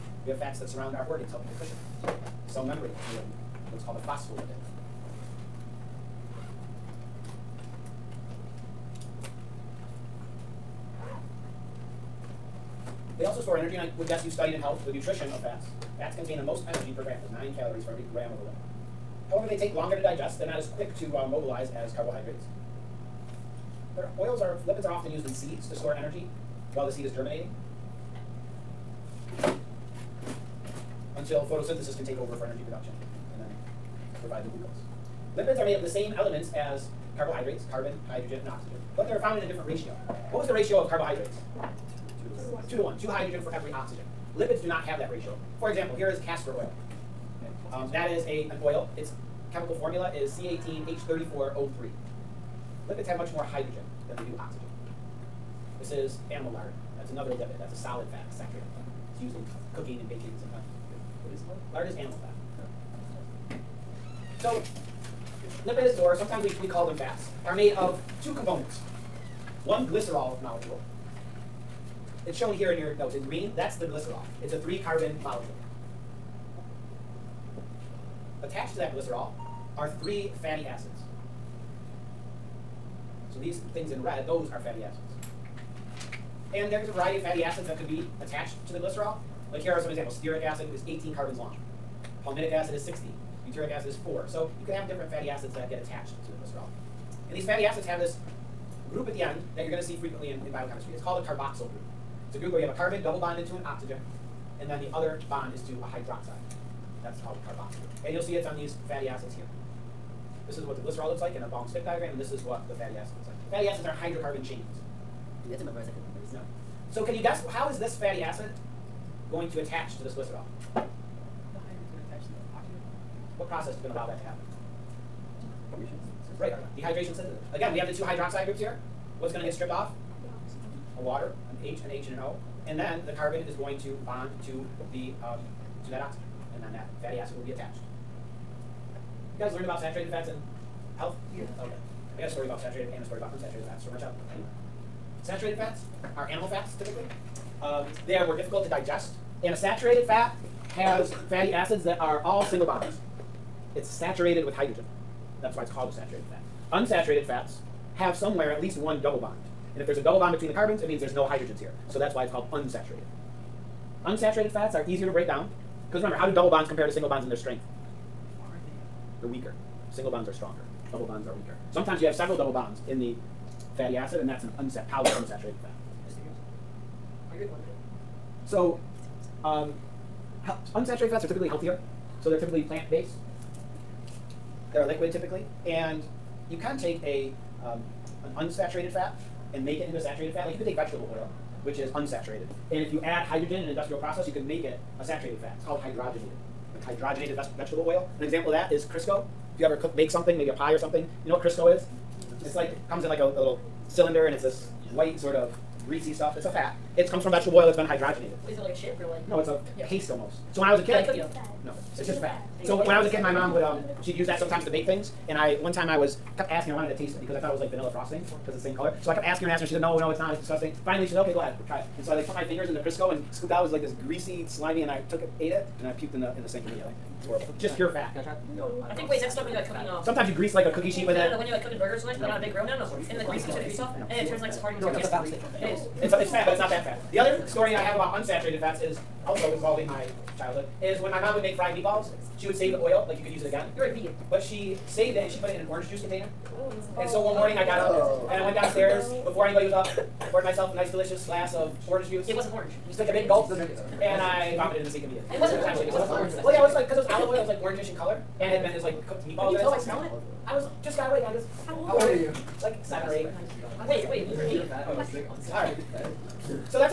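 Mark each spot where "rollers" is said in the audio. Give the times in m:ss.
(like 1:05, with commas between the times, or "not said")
not said.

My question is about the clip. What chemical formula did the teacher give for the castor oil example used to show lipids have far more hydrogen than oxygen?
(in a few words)
C18H34O3.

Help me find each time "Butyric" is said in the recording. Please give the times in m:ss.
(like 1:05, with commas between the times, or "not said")
1:33.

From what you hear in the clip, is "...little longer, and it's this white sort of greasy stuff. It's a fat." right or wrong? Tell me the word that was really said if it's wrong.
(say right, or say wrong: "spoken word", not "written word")
wrong: "cylinder", not "longer".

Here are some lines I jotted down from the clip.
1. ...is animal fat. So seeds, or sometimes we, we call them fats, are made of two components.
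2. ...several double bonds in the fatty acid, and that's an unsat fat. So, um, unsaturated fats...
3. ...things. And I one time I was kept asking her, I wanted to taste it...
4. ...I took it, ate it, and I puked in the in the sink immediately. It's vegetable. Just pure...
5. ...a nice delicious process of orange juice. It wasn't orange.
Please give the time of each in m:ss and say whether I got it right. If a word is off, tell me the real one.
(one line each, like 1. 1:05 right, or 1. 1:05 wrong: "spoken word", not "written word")
1. 1:01 wrong: "lipids", not "seeds"
2. 2:52 right
3. 3:34 right
4. 3:44 wrong: "horrible", not "vegetable"
5. 4:10 wrong: "glass", not "process".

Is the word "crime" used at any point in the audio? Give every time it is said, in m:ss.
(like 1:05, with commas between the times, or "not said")
not said.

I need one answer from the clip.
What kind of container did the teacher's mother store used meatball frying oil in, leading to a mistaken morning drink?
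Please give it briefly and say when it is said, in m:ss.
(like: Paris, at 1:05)
Orange juice container, at 4:05.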